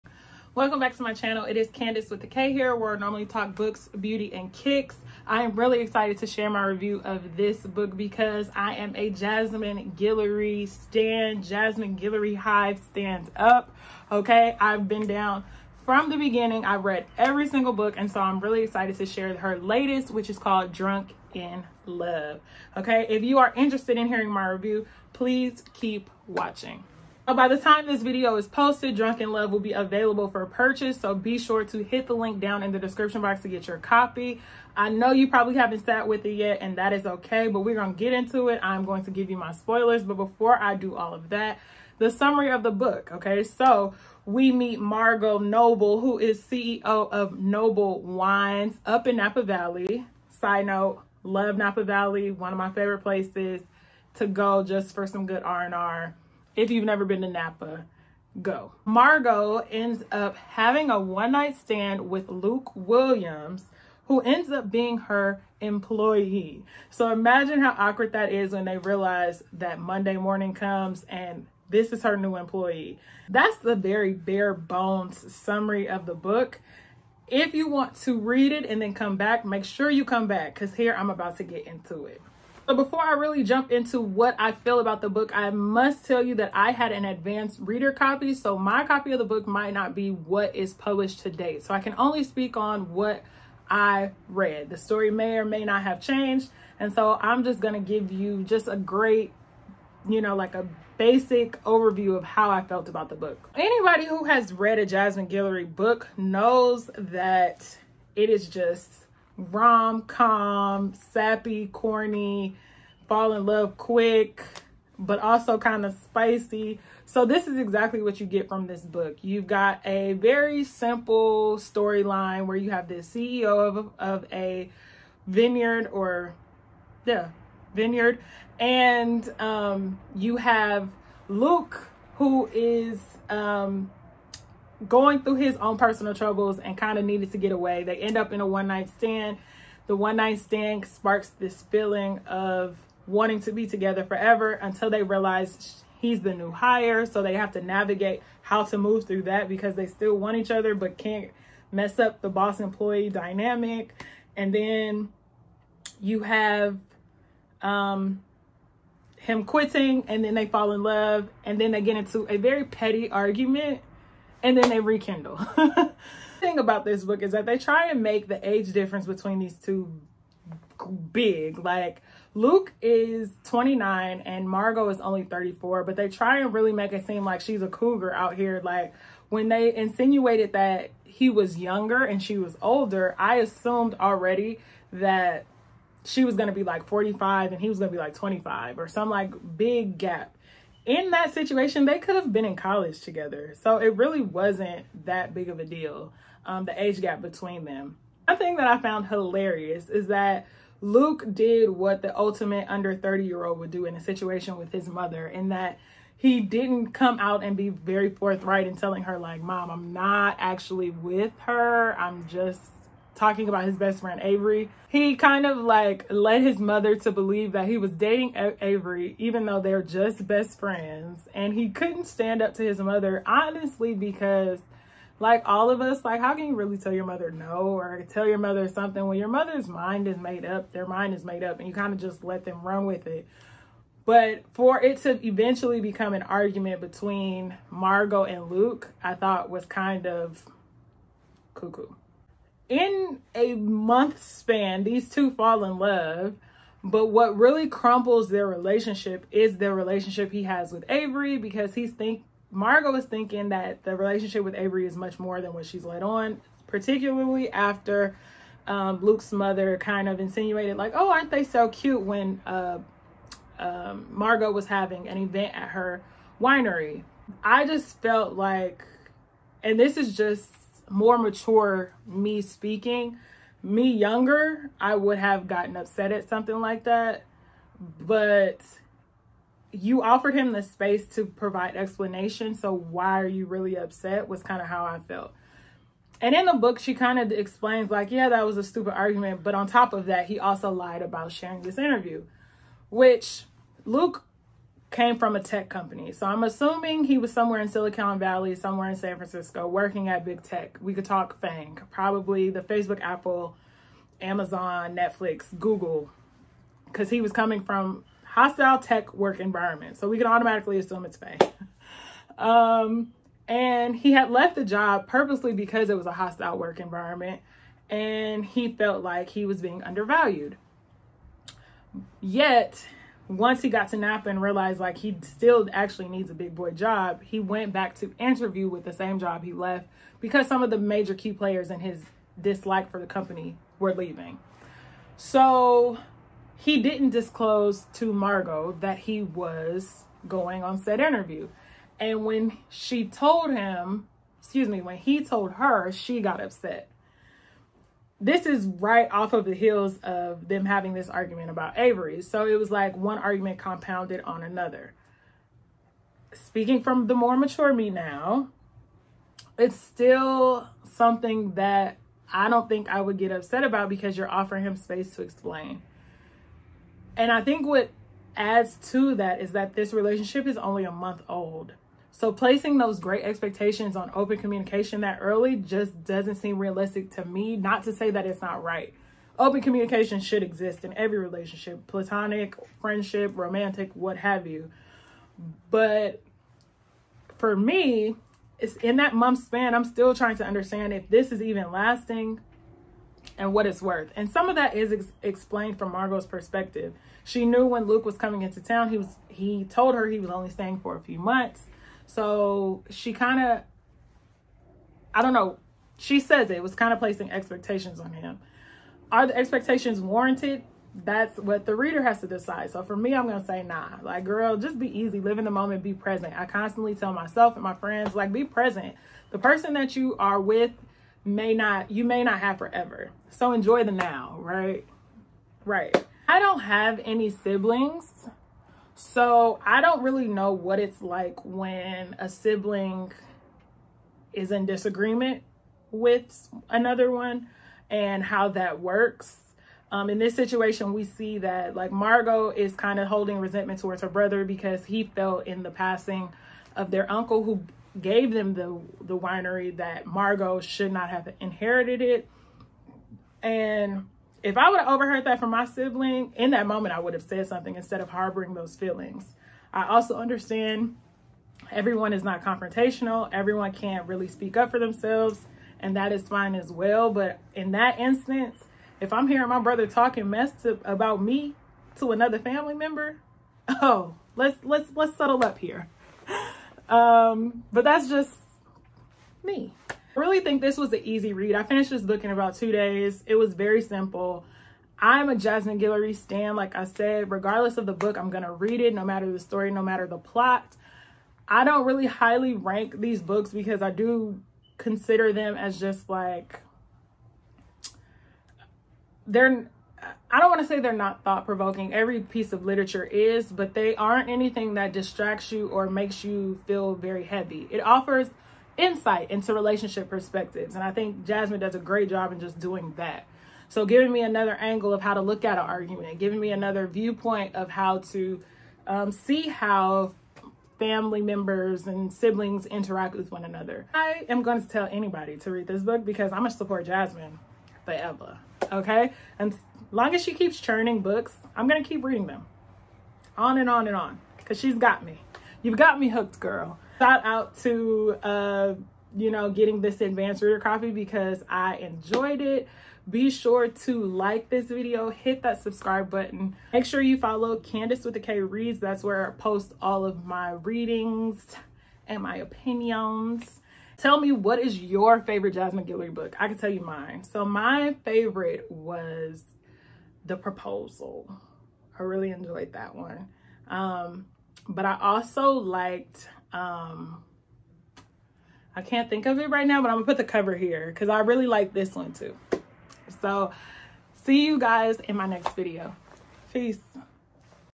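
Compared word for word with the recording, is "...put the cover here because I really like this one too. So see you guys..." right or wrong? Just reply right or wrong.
right.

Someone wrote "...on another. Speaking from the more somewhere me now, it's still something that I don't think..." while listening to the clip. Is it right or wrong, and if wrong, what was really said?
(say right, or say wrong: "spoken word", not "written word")
wrong: "mature", not "somewhere".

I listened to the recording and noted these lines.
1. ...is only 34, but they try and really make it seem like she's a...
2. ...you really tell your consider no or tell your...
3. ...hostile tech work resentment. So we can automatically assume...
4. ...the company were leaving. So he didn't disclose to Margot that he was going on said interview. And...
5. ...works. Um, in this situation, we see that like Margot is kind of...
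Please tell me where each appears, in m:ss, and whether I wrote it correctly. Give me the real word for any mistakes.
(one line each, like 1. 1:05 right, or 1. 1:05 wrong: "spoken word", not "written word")
1. 2:54 right
2. 3:46 wrong: "mother", not "consider"
3. 5:08 wrong: "environment", not "resentment"
4. 5:32 right
5. 7:18 right.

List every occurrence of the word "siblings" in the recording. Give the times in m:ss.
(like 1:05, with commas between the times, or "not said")
7:07, 7:12, 7:35, 8:42.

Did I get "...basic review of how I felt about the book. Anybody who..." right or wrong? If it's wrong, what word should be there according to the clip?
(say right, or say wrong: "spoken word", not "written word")
wrong: "overview", not "review".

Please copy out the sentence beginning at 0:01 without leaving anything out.
It is Kandace with the K here, where I normally talk books, beauty, and kicks.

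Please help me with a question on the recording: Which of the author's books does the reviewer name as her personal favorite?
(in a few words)
The Proposal.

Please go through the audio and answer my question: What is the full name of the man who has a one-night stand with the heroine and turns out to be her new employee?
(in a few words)
Luke Williams.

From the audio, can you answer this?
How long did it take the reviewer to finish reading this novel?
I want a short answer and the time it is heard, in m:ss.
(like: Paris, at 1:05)
2 days, at 8:02.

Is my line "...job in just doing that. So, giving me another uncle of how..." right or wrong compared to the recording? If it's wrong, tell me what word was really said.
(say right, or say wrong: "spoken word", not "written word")
wrong: "angle", not "uncle".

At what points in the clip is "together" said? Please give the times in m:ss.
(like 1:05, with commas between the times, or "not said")
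2:23, 3:13.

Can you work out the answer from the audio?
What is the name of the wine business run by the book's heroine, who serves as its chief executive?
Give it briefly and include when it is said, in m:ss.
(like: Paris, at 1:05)
Noble Wines, at 0:47.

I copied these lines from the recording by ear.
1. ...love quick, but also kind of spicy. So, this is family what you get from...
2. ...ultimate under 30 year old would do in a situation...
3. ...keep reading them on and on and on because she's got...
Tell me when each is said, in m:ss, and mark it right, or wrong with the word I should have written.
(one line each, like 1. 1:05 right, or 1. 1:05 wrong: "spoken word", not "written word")
1. 1:53 wrong: "exactly", not "family"
2. 3:22 right
3. 8:51 right.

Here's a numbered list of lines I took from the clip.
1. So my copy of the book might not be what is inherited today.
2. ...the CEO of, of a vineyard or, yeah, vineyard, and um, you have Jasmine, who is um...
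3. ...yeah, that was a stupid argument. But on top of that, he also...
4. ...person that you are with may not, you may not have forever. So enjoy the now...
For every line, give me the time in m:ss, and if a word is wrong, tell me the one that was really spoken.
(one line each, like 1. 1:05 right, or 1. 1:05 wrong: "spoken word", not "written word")
1. 1:28 wrong: "published", not "inherited"
2. 2:02 wrong: "Luke", not "Jasmine"
3. 4:48 right
4. 6:59 right.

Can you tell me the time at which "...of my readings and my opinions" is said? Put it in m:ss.
9:10.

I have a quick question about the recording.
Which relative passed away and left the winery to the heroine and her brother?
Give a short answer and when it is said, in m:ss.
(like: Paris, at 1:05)
Their uncle, at 7:27.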